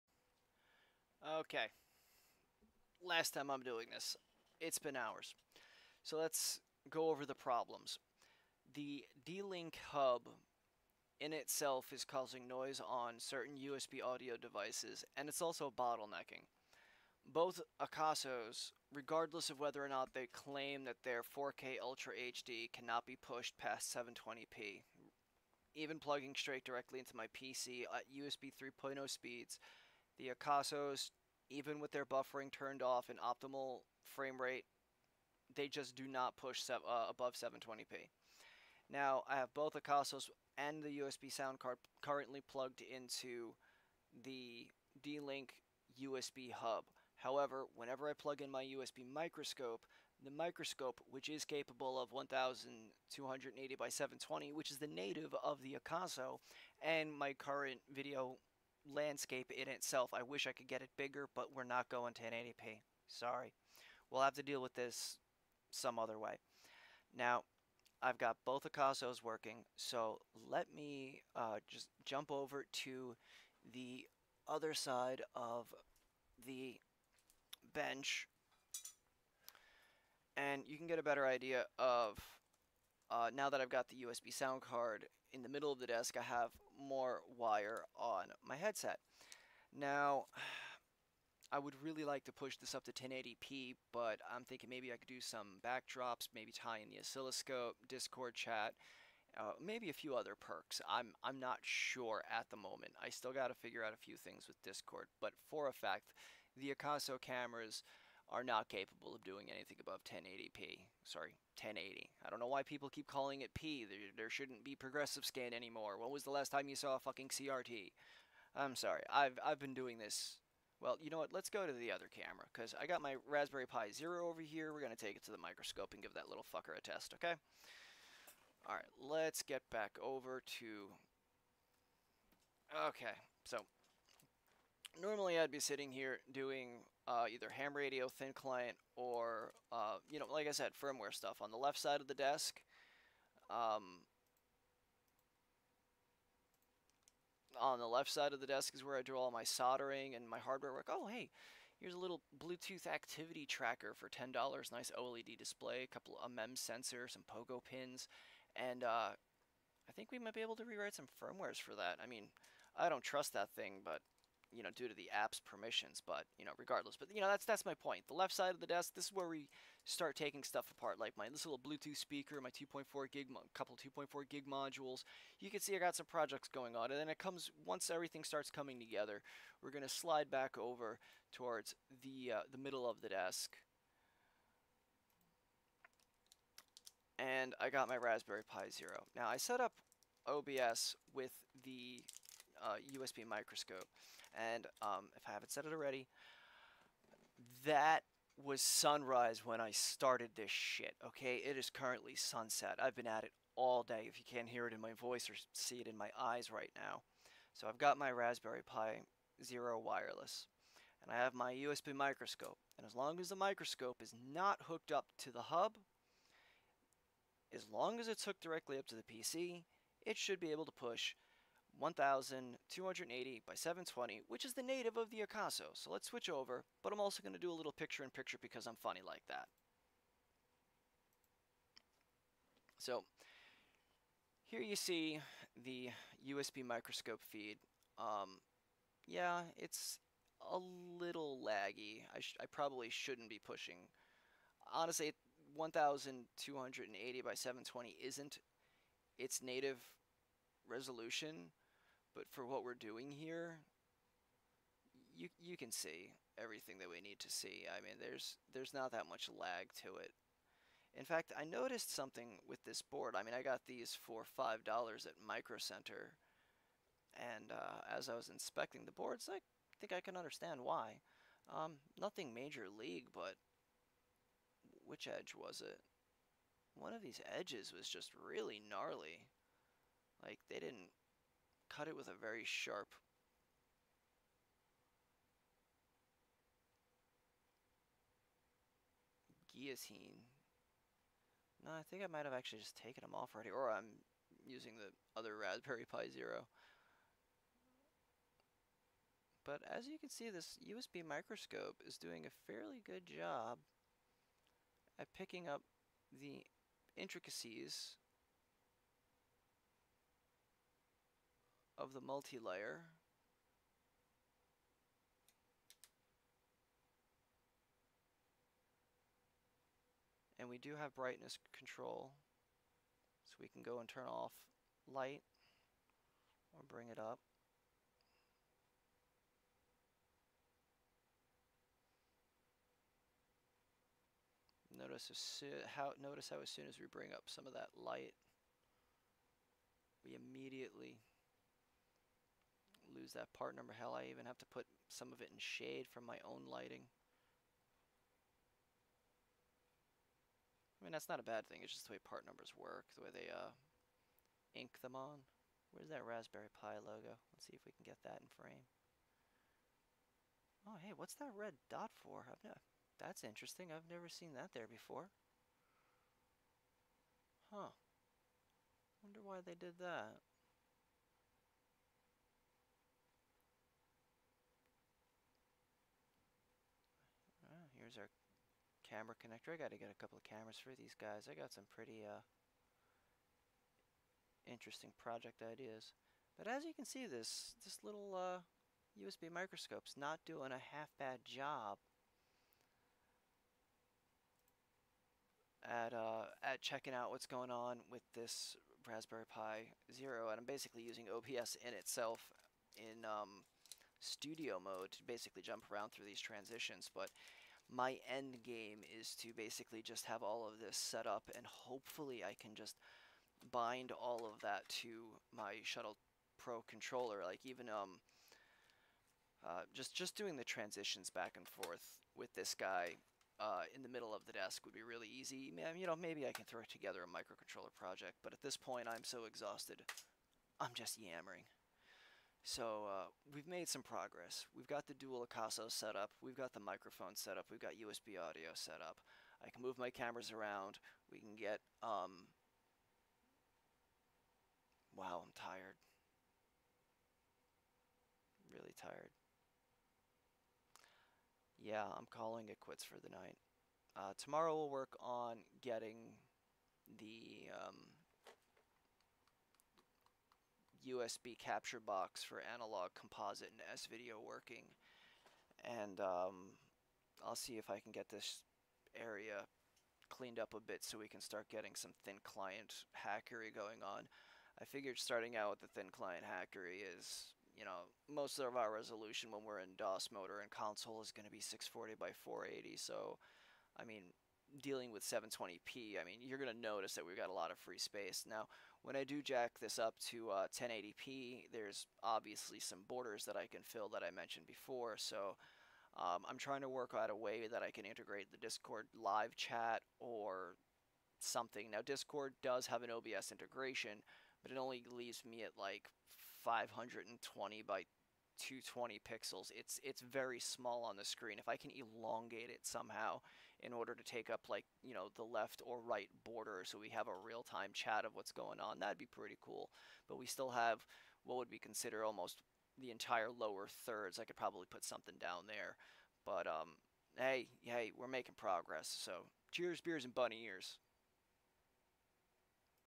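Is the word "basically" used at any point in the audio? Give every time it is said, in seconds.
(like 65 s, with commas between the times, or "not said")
400 s, 405 s, 409 s.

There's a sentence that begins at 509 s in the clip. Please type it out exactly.
It's it's very small on the screen.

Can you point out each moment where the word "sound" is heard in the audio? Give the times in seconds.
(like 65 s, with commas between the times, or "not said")
41 s, 84 s.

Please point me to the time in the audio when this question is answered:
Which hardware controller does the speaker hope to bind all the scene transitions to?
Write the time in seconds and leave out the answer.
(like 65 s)
415 s.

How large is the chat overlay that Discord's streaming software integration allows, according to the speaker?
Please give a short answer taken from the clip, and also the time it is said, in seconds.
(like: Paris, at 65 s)
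520 by 220 pixels, at 506 s.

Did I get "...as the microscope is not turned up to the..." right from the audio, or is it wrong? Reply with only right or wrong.
wrong.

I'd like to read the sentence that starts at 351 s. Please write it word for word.
It's just the way part numbers work, the way they uh, ink them on.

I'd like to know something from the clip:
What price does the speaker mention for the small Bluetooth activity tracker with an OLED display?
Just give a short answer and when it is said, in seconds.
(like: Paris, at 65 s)
$10, at 154 s.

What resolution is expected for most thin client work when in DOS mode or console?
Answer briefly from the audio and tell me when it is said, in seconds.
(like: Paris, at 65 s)
640 by 480, at 481 s.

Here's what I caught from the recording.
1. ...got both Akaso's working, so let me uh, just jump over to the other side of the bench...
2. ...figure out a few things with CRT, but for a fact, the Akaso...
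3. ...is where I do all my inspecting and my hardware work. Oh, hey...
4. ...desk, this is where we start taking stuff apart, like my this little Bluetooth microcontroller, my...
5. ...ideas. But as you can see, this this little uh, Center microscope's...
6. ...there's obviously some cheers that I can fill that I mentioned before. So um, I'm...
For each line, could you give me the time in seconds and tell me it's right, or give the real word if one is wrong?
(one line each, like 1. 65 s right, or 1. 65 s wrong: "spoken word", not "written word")
1. 68 s right
2. 103 s wrong: "Discord", not "CRT"
3. 148 s wrong: "soldering", not "inspecting"
4. 168 s wrong: "speaker", not "microcontroller"
5. 385 s wrong: "USB", not "Center"
6. 491 s wrong: "borders", not "cheers".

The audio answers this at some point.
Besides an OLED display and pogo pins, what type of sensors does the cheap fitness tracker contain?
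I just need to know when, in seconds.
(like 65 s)
156 s.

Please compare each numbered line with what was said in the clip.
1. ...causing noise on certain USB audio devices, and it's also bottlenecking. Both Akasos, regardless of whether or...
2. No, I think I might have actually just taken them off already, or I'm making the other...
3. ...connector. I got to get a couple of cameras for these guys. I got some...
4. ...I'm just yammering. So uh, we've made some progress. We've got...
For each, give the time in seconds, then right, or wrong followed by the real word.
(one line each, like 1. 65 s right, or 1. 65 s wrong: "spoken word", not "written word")
1. 12 s right
2. 291 s wrong: "using", not "making"
3. 379 s right
4. 430 s right.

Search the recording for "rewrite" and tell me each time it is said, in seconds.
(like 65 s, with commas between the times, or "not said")
160 s.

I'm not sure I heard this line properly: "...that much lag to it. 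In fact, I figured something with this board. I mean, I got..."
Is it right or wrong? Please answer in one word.
wrong.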